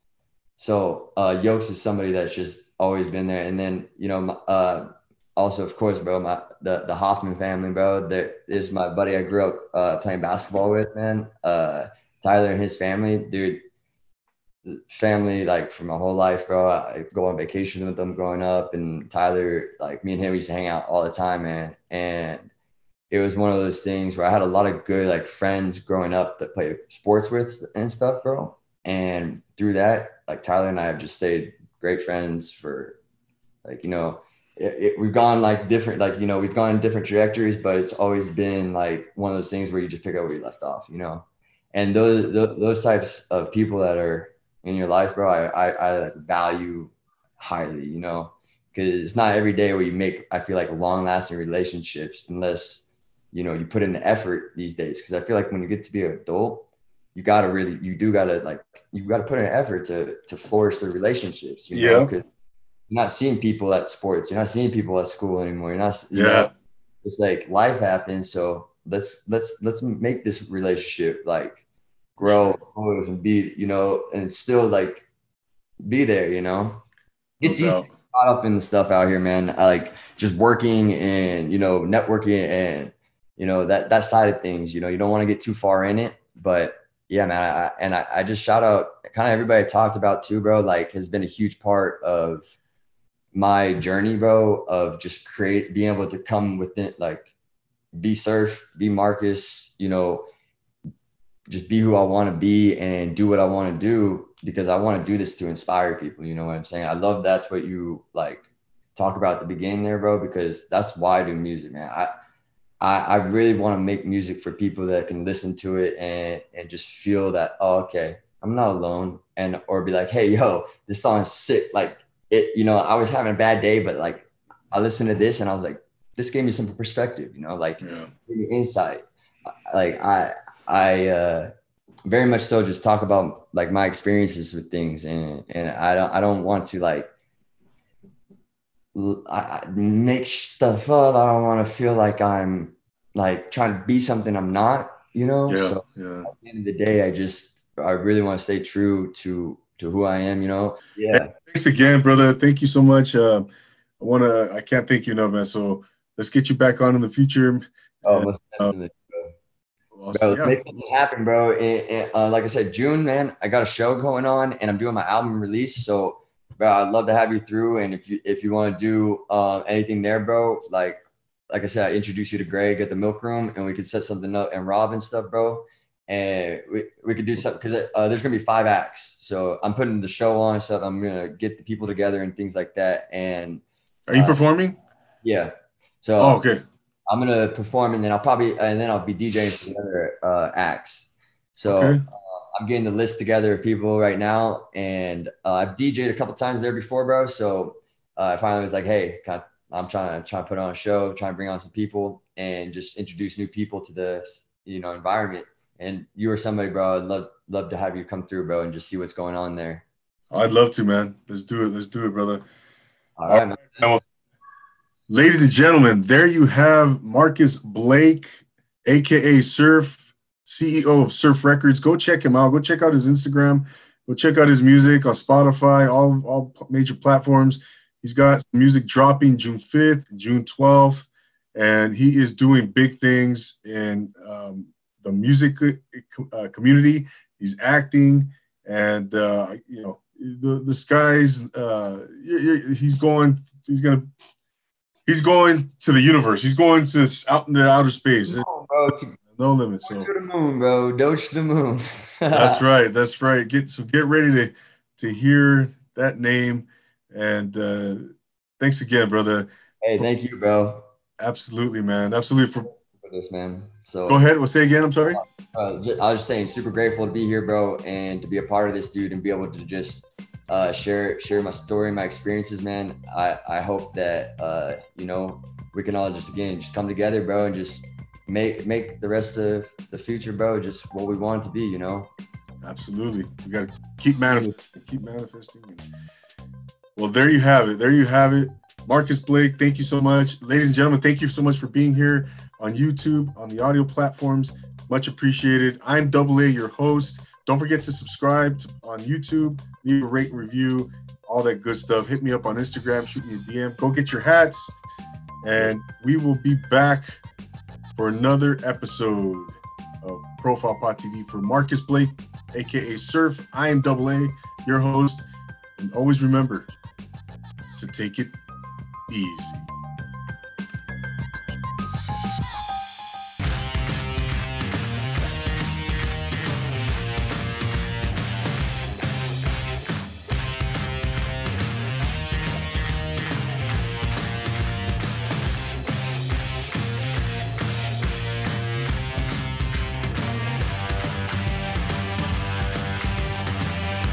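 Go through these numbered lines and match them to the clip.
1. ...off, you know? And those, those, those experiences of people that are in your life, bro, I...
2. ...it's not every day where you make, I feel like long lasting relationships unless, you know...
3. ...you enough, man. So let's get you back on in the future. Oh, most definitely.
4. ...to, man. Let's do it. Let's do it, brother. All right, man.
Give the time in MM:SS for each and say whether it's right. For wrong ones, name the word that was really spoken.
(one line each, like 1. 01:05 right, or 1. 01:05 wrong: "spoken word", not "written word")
1. 00:40 wrong: "types", not "experiences"
2. 00:49 right
3. 02:35 right
4. 03:30 right.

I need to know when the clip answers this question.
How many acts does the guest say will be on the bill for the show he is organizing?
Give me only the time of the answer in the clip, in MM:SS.
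02:58.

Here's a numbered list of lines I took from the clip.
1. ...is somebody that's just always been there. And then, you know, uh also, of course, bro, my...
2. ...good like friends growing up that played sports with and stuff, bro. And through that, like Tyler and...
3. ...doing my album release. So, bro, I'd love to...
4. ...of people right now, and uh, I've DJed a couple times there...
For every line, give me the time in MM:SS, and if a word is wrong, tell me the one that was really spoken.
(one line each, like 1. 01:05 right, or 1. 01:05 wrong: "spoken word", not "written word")
1. 00:01 right
2. 00:24 right
3. 02:44 right
4. 03:13 right.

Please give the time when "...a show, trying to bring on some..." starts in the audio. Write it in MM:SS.
03:20.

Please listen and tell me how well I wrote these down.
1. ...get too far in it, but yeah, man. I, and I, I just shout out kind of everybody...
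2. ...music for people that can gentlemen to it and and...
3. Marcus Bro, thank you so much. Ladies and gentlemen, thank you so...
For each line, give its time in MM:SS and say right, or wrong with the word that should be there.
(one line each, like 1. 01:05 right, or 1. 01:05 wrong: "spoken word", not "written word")
1. 01:25 right
2. 01:54 wrong: "listen", not "gentlemen"
3. 04:48 wrong: "Blake", not "Bro".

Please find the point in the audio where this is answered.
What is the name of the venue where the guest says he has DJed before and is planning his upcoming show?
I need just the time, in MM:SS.
02:52.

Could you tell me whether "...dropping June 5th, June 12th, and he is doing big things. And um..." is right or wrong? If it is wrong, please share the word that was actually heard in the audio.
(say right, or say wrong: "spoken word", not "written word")
right.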